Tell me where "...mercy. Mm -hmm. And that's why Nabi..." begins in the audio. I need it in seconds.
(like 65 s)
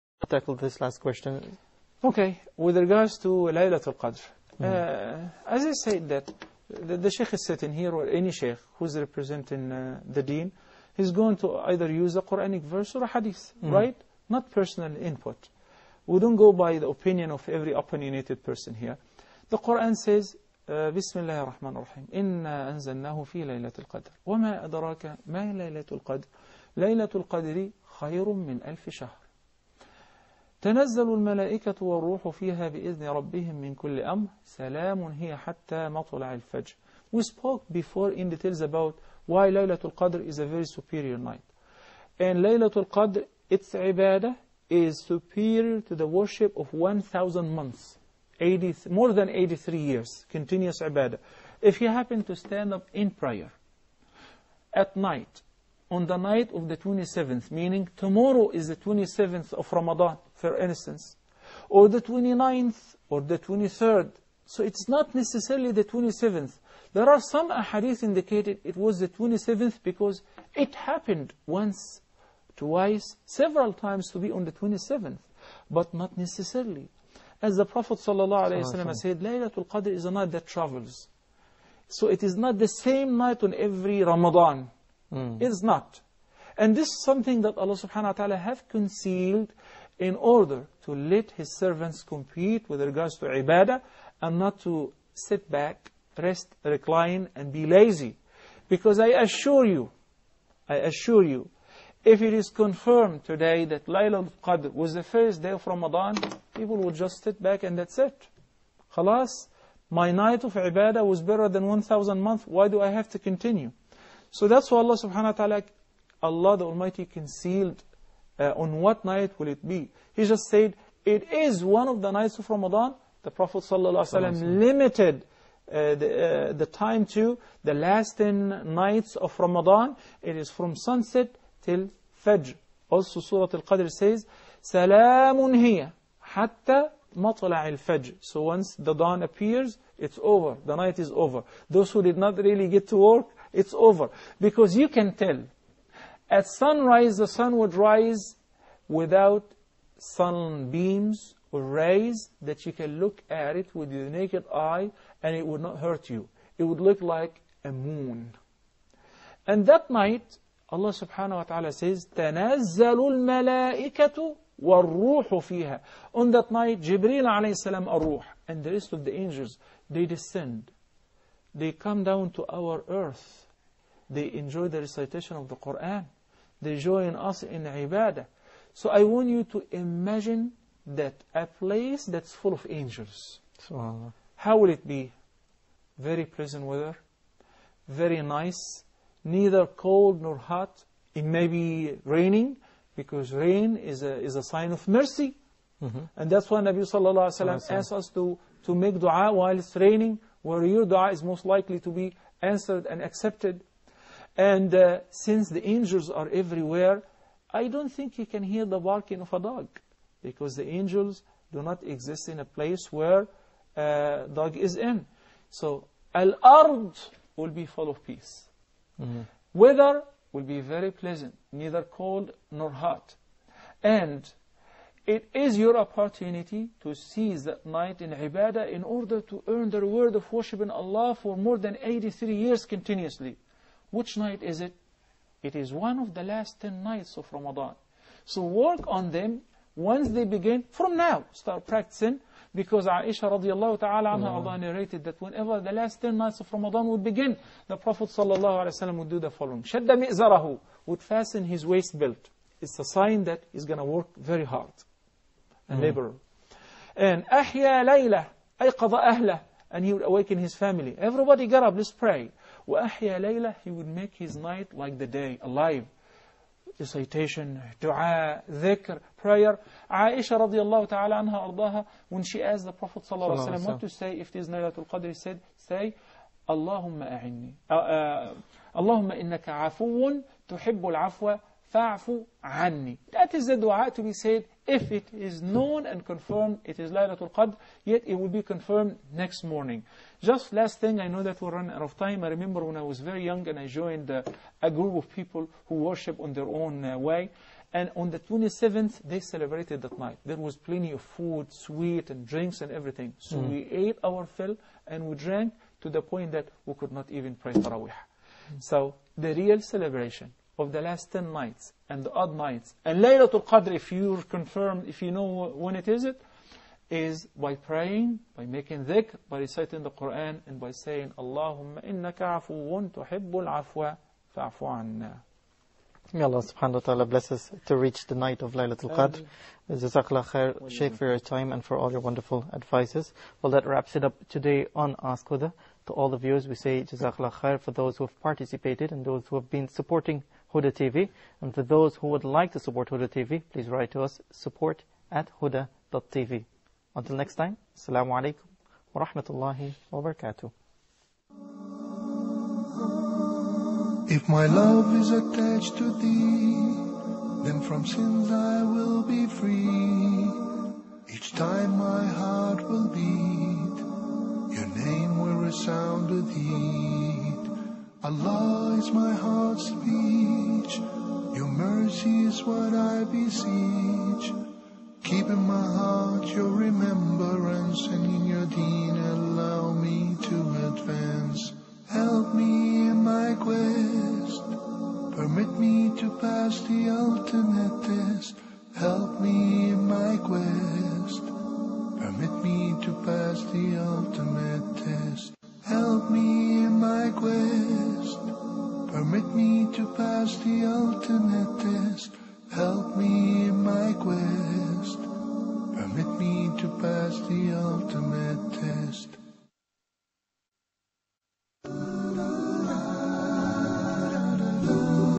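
194 s.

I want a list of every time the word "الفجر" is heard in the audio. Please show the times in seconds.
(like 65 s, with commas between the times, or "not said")
36 s, 137 s.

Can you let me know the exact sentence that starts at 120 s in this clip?
He just said, it is one of the nights of Ramadan.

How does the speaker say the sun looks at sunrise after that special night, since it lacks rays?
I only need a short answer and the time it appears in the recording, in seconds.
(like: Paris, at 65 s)
like a moon, at 156 s.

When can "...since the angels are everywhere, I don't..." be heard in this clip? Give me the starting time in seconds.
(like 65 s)
205 s.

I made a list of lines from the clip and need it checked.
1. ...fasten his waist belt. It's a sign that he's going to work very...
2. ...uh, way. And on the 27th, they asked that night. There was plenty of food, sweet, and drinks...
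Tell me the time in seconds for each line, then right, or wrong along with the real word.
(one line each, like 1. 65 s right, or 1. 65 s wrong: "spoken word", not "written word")
1. 251 s right
2. 296 s wrong: "celebrated", not "asked".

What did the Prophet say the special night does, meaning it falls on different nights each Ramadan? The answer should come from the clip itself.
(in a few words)
travels.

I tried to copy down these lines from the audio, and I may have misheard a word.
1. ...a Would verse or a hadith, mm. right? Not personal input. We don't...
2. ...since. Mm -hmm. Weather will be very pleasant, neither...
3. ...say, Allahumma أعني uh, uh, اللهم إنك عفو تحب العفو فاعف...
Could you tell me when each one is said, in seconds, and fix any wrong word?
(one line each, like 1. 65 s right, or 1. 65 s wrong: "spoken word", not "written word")
1. 12 s wrong: "Quranic", not "Would"
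2. 218 s wrong: "peace", not "since"
3. 275 s right.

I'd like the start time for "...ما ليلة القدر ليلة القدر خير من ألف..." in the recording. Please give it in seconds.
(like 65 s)
25 s.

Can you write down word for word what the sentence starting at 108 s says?
Khalas, my night of ibadah was better than 1,000 months, why do I have to continue?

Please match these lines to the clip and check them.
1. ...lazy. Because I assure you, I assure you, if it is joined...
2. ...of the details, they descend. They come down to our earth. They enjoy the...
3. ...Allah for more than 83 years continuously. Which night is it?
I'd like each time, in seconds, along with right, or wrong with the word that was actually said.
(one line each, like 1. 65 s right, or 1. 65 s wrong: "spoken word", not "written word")
1. 97 s wrong: "confirmed", not "joined"
2. 168 s wrong: "angels", not "details"
3. 230 s right.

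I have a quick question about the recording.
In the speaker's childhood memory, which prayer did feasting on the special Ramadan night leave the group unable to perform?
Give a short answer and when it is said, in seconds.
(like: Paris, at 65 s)
Tarawih, at 307 s.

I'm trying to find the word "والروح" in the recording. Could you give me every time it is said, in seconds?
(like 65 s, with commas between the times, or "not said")
31 s, 164 s.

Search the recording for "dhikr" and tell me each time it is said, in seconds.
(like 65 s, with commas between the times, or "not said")
268 s, 318 s.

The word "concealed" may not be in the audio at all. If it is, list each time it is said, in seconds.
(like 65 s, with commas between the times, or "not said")
88 s, 117 s.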